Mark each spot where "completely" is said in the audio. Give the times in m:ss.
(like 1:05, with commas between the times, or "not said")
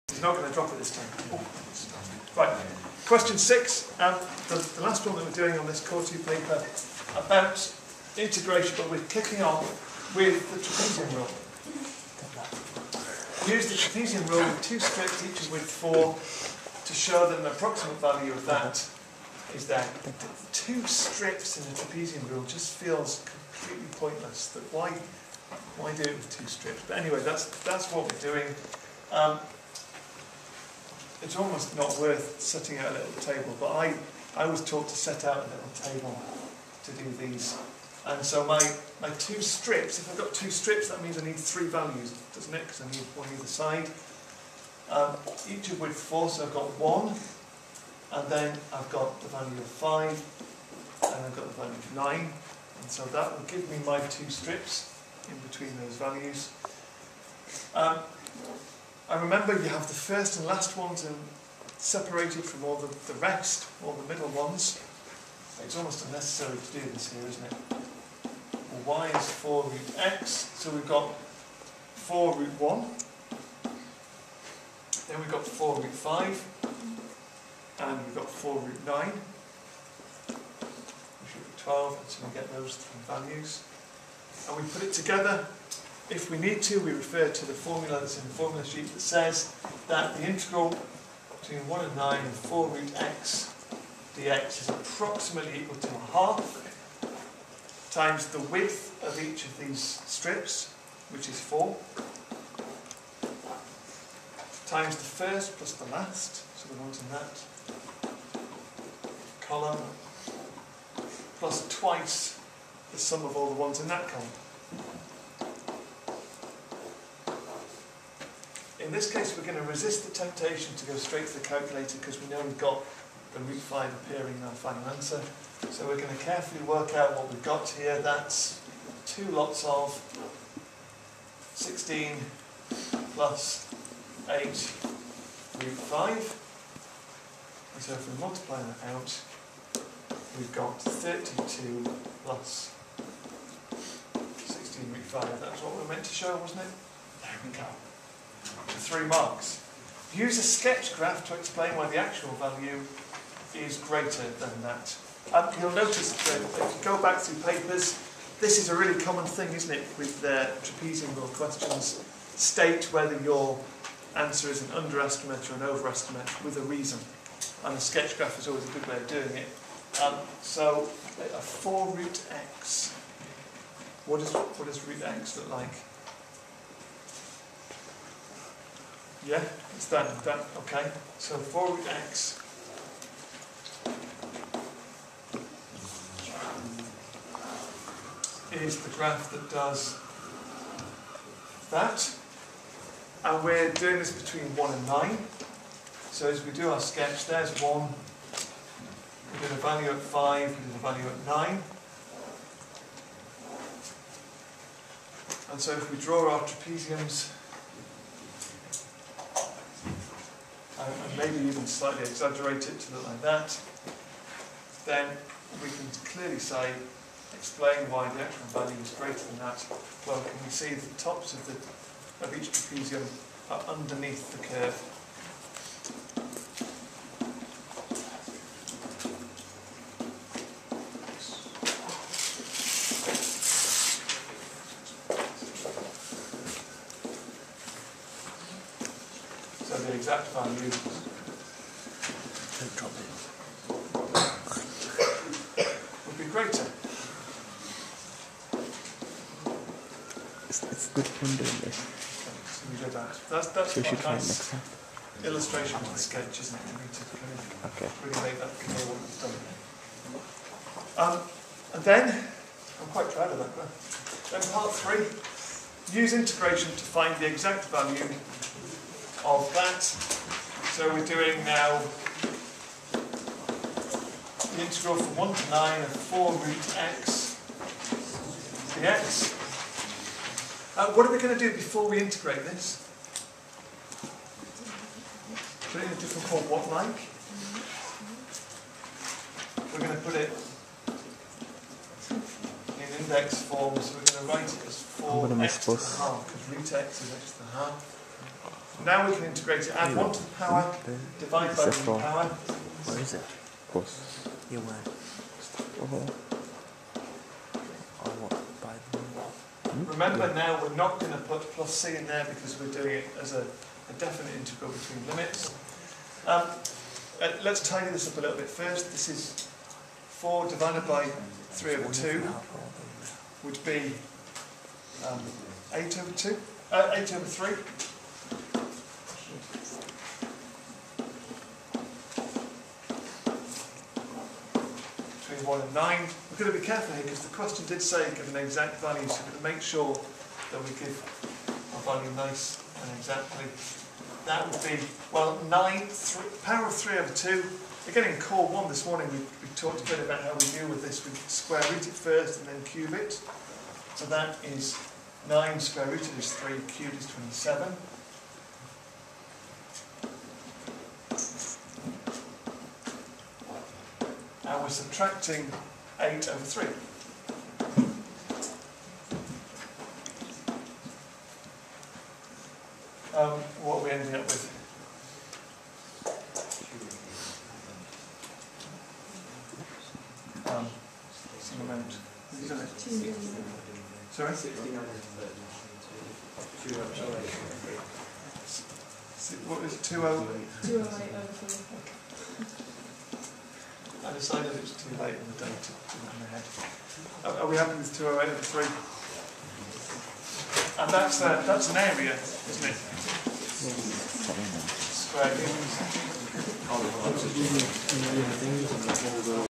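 0:23.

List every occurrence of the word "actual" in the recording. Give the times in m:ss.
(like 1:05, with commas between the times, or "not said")
2:31, 3:38.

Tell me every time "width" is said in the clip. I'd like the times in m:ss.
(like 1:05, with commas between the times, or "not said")
1:38.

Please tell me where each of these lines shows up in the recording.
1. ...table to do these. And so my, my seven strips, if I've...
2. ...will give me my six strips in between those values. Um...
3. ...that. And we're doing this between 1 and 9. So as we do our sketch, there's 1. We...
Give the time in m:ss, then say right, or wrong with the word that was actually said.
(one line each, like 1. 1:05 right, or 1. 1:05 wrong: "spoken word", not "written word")
1. 0:35 wrong: "two", not "seven"
2. 0:53 wrong: "two", not "six"
3. 3:11 right.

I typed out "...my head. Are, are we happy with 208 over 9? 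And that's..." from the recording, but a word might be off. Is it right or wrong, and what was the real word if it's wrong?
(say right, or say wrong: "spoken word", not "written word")
wrong: "3", not "9".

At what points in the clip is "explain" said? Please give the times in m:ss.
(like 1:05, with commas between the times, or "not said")
2:31, 3:37.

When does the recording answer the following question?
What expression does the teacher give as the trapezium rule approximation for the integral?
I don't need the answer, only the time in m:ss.
2:20.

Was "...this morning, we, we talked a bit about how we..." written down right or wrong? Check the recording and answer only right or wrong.
right.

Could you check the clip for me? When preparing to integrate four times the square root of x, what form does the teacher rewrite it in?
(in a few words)
index form.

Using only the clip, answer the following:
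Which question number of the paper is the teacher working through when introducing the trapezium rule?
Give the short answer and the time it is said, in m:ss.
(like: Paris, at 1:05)
six, at 0:03.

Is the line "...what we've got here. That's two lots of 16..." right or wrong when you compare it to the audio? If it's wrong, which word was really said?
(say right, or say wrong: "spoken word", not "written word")
right.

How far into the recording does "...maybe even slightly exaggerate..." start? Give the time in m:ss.
3:31.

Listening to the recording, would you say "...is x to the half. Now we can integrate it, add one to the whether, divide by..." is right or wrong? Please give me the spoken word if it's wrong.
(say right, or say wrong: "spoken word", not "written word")
wrong: "power", not "whether".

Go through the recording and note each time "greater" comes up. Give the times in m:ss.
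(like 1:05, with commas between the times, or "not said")
2:33, 3:38, 4:06.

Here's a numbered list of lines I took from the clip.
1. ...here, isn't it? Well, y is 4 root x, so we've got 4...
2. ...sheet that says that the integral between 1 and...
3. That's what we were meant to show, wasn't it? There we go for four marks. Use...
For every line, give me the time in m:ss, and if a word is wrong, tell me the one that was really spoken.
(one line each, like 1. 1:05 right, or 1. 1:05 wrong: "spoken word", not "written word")
1. 1:07 right
2. 1:28 right
3. 2:25 wrong: "three", not "four".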